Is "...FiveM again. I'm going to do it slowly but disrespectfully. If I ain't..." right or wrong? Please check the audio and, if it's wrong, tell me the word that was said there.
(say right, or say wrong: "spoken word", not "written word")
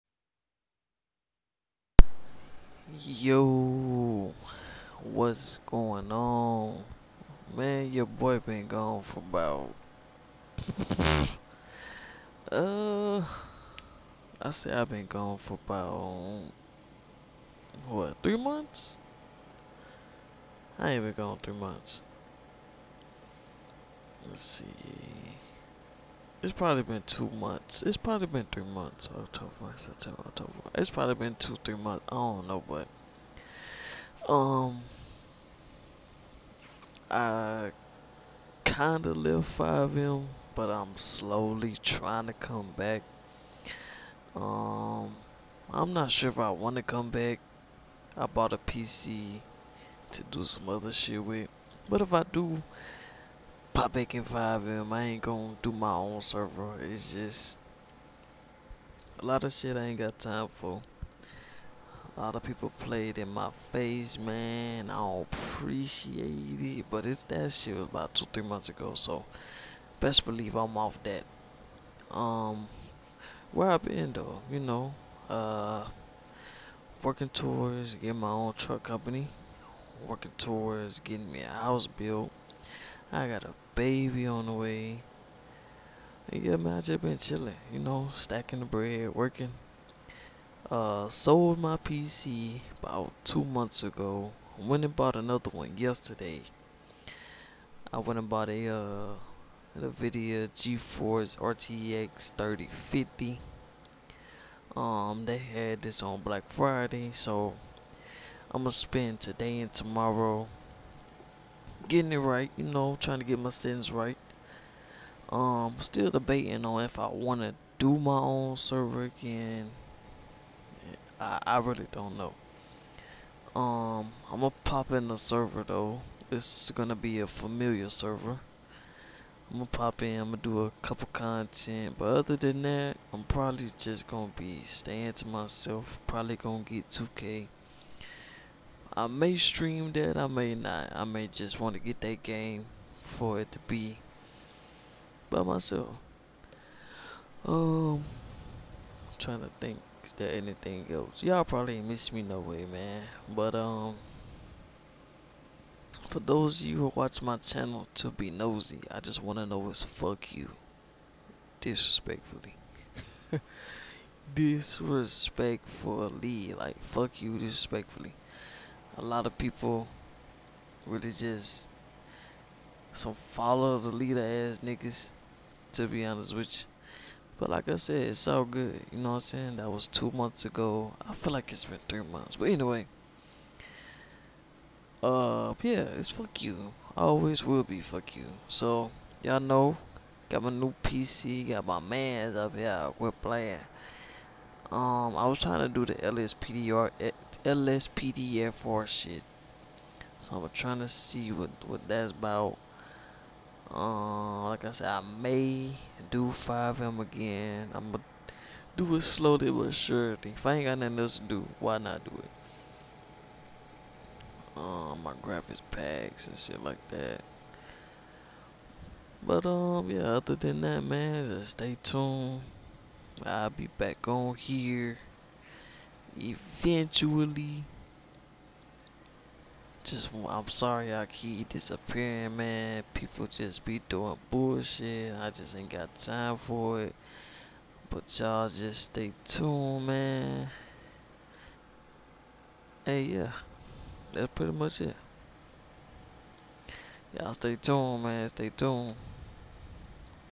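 wrong: "surely", not "disrespectfully".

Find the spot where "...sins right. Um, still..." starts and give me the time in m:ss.
1:53.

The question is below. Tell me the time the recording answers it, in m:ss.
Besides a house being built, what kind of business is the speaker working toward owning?
1:18.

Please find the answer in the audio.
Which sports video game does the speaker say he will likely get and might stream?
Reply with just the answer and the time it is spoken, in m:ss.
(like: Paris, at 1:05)
2K, at 2:16.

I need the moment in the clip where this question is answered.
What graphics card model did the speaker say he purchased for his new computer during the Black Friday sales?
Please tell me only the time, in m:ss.
1:39.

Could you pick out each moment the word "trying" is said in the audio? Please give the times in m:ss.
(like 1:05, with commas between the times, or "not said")
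0:41, 1:52, 2:29, 3:15, 3:20.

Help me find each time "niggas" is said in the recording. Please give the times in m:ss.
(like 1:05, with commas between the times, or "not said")
2:54.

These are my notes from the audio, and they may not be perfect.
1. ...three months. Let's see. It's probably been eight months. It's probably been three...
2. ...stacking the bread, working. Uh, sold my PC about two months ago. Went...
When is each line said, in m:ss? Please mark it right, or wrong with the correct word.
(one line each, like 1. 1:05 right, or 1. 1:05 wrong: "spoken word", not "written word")
1. 0:21 wrong: "two", not "eight"
2. 1:28 right.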